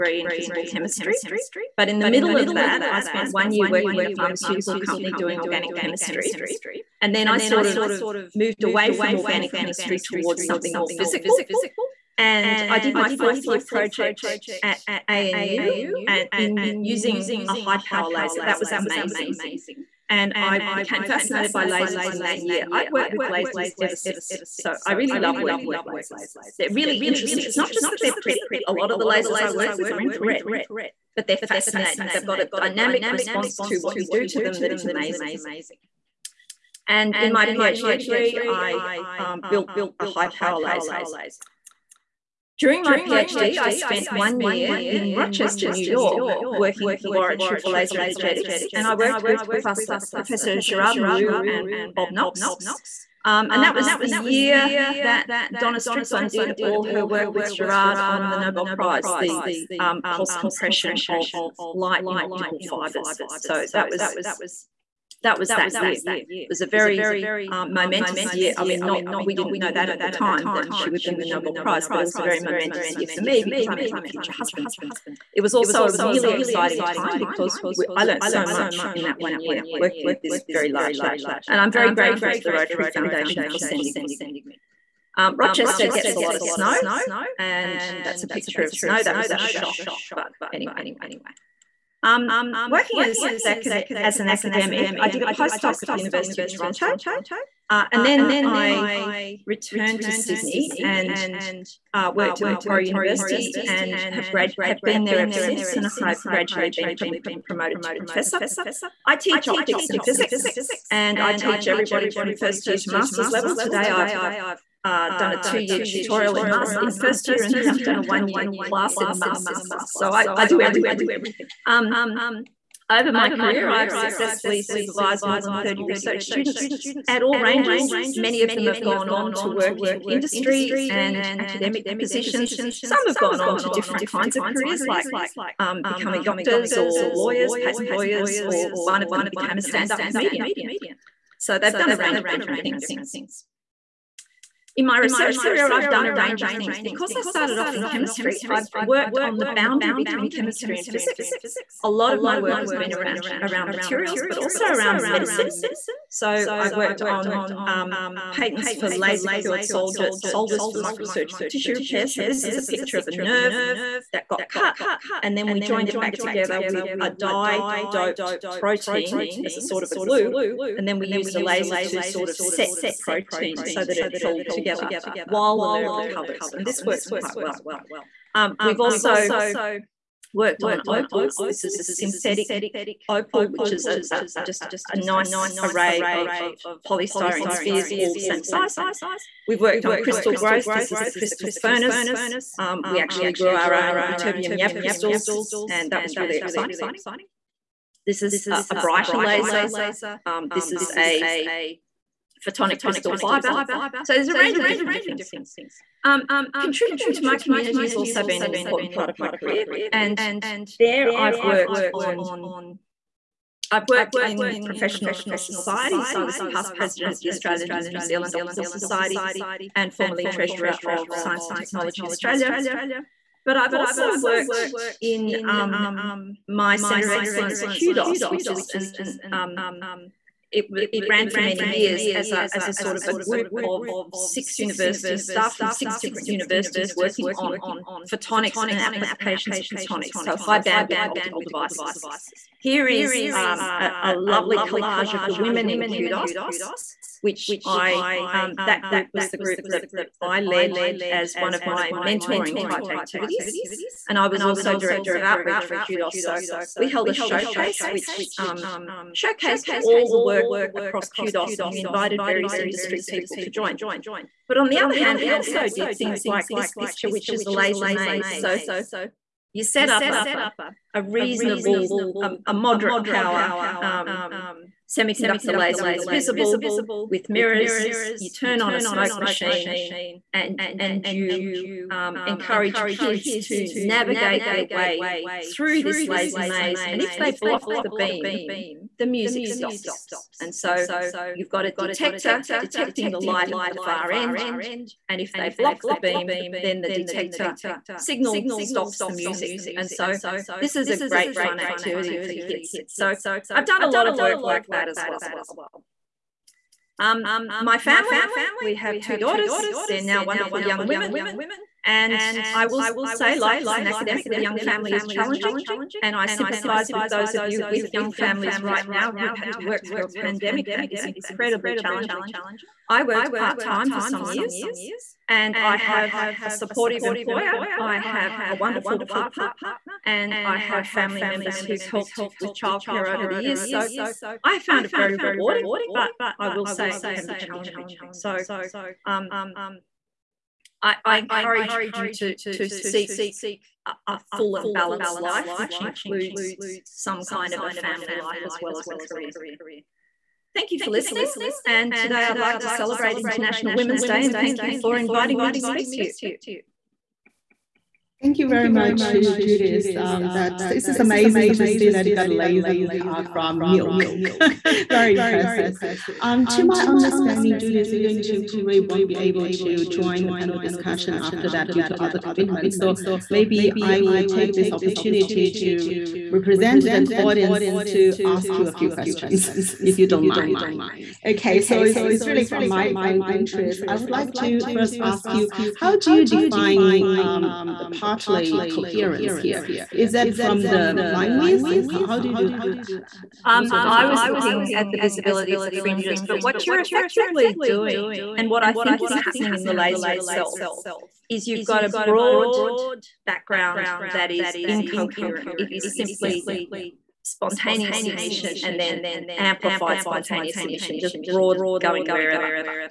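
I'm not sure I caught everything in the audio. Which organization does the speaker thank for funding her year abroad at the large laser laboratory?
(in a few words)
Rotary Foundation.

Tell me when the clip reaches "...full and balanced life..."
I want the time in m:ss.
5:44.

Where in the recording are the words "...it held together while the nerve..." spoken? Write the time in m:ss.
2:53.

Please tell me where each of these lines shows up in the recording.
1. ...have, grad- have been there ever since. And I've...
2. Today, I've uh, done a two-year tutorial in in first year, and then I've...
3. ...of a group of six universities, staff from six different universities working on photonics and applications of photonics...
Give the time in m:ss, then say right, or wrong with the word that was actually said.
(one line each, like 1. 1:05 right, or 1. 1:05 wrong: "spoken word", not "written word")
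1. 1:44 right
2. 1:53 right
3. 3:52 right.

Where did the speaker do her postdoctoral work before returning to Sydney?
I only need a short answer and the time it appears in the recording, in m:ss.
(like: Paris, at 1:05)
University of Toronto, at 1:35.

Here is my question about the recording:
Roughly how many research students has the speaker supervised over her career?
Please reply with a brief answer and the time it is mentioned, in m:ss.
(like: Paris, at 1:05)
more than 30, at 2:05.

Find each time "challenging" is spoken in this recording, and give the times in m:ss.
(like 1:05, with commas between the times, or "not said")
5:15, 5:21, 5:37.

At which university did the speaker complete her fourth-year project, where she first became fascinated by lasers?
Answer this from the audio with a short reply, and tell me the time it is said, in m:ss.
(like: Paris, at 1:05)
ANU, at 0:15.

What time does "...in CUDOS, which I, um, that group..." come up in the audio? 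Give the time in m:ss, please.
4:05.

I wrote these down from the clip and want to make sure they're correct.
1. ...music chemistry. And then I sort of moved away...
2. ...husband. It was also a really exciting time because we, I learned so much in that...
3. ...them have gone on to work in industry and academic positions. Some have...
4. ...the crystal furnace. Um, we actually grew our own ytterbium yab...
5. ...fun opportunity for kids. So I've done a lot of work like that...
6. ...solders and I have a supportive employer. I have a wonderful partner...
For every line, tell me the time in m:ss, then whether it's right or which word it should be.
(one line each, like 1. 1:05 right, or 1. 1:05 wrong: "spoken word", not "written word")
1. 0:05 wrong: "organic", not "music"
2. 1:14 right
3. 2:08 right
4. 3:11 right
5. 5:01 wrong: "activity", not "opportunity"
6. 5:24 wrong: "years", not "solders".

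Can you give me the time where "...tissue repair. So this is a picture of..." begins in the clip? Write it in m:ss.
2:41.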